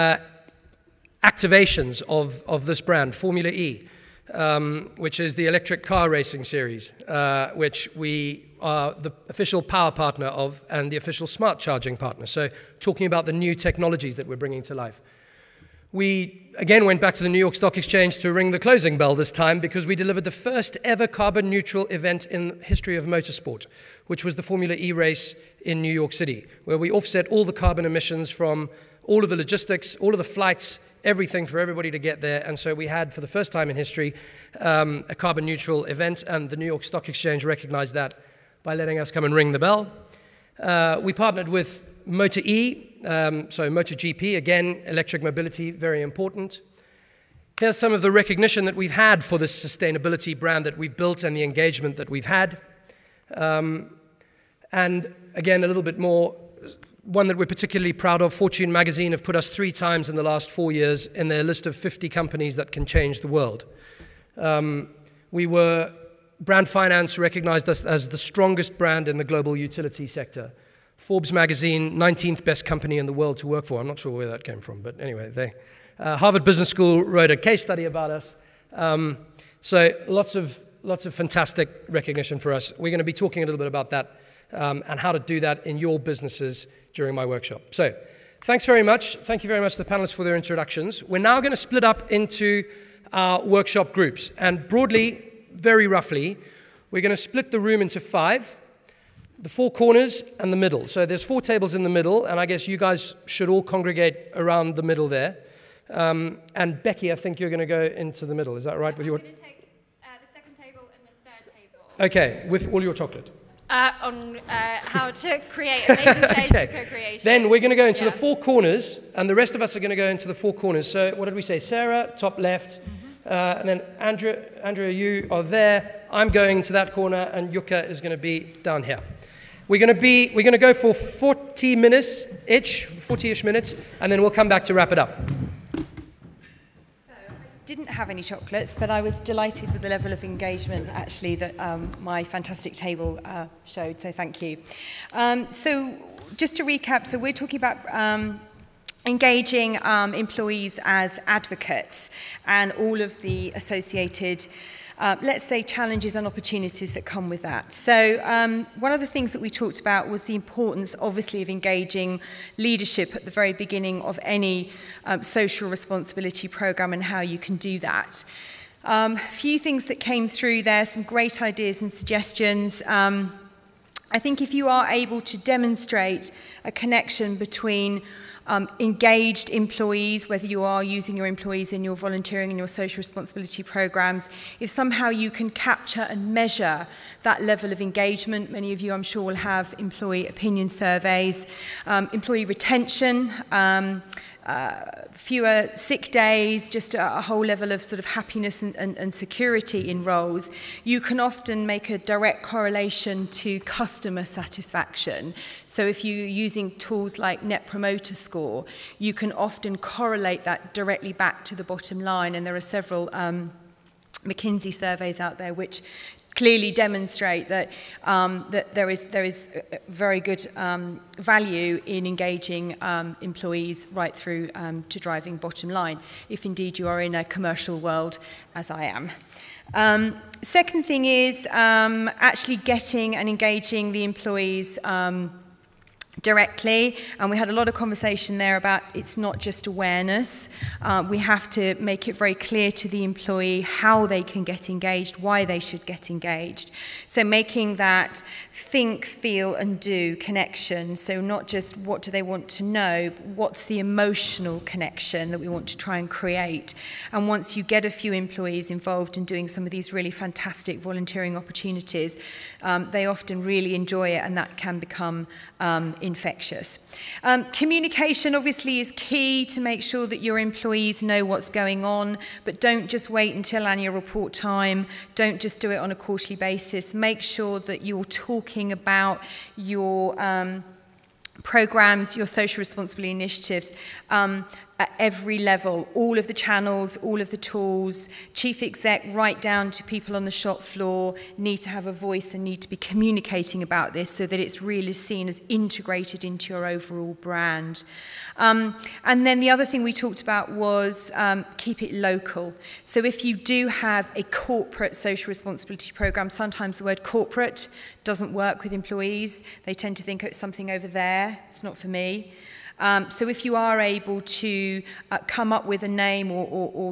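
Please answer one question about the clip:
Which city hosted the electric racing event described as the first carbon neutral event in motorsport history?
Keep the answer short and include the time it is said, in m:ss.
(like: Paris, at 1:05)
New York City, at 0:25.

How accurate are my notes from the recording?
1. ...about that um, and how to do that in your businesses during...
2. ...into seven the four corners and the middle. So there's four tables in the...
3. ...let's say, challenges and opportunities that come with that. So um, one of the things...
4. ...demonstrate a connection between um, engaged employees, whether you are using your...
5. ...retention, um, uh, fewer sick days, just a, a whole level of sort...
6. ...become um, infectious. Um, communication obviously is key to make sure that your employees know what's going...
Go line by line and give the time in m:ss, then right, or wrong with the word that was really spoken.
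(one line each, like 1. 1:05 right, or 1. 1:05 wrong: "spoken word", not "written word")
1. 1:23 right
2. 1:37 wrong: "five", not "seven"
3. 2:35 right
4. 2:55 right
5. 3:12 right
6. 4:24 right.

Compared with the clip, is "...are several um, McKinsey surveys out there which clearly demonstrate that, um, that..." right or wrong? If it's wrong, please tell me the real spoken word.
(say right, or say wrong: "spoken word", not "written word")
right.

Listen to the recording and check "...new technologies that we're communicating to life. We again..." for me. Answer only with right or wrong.
wrong.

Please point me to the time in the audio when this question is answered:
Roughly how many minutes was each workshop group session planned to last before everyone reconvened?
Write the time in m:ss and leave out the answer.
2:10.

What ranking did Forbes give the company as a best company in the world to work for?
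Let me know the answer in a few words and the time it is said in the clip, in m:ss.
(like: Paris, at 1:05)
19th, at 1:11.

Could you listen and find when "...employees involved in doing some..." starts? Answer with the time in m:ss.
4:18.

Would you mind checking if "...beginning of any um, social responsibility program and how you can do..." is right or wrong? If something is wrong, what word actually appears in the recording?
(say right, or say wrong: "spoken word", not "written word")
right.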